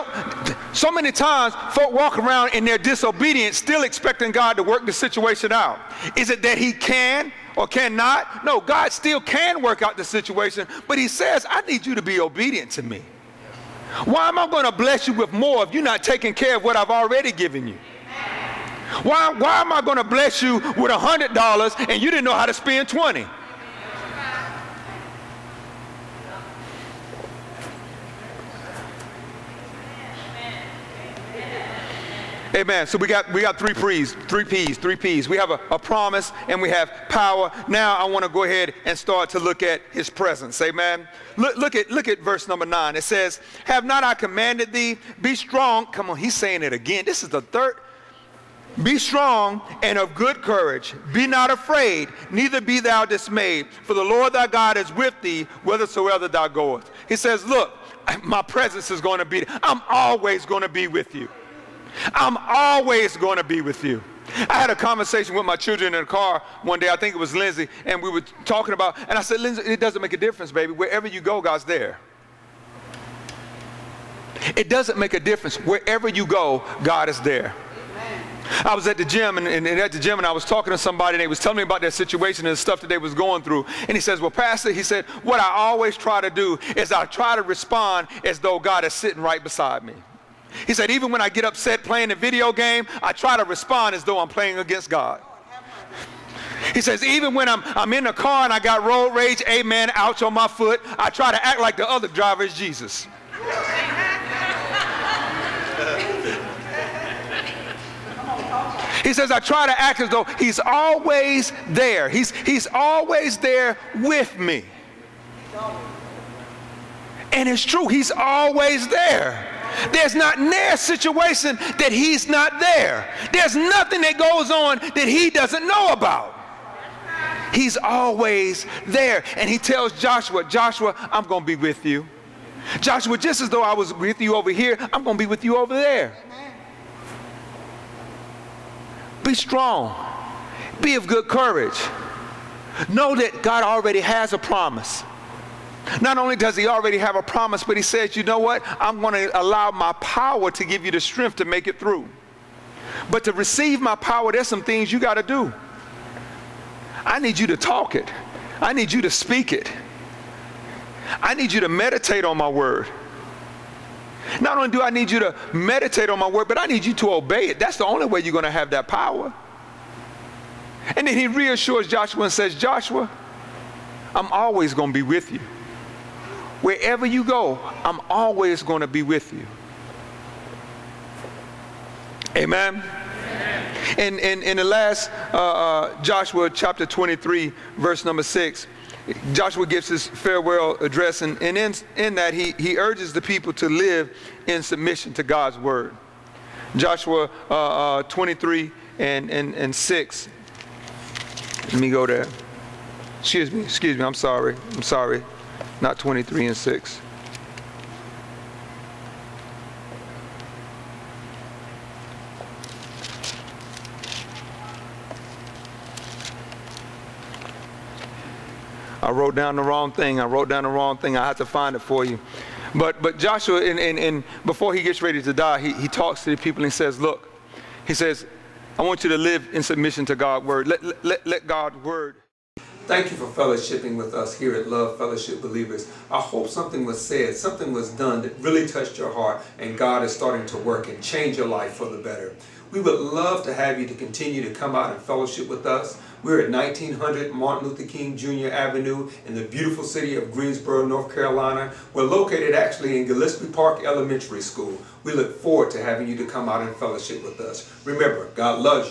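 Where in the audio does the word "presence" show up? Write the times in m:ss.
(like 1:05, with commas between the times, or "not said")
0:40, 0:58.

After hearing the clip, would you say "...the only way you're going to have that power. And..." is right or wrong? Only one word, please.
right.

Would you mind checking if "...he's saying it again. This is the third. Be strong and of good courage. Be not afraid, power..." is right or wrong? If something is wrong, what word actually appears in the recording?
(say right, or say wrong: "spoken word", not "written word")
wrong: "neither", not "power".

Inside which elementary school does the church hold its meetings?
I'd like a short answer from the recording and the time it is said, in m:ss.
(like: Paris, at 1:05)
Gillespie Park Elementary School, at 4:13.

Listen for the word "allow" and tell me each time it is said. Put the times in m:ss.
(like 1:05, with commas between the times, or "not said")
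2:29.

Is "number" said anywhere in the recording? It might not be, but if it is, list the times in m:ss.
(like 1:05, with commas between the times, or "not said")
0:42, 3:08.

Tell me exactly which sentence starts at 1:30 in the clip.
He said, even when I get upset playing a video game, I try to respond as though I'm playing against God.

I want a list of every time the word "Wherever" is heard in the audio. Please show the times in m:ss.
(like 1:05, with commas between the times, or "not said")
1:10, 1:15, 2:56.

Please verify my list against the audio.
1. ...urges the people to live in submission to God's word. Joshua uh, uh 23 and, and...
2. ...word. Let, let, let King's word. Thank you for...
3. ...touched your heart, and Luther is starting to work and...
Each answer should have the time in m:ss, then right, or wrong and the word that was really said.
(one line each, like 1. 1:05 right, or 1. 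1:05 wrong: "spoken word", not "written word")
1. 3:12 right
2. 3:50 wrong: "God", not "King"
3. 3:58 wrong: "God", not "Luther".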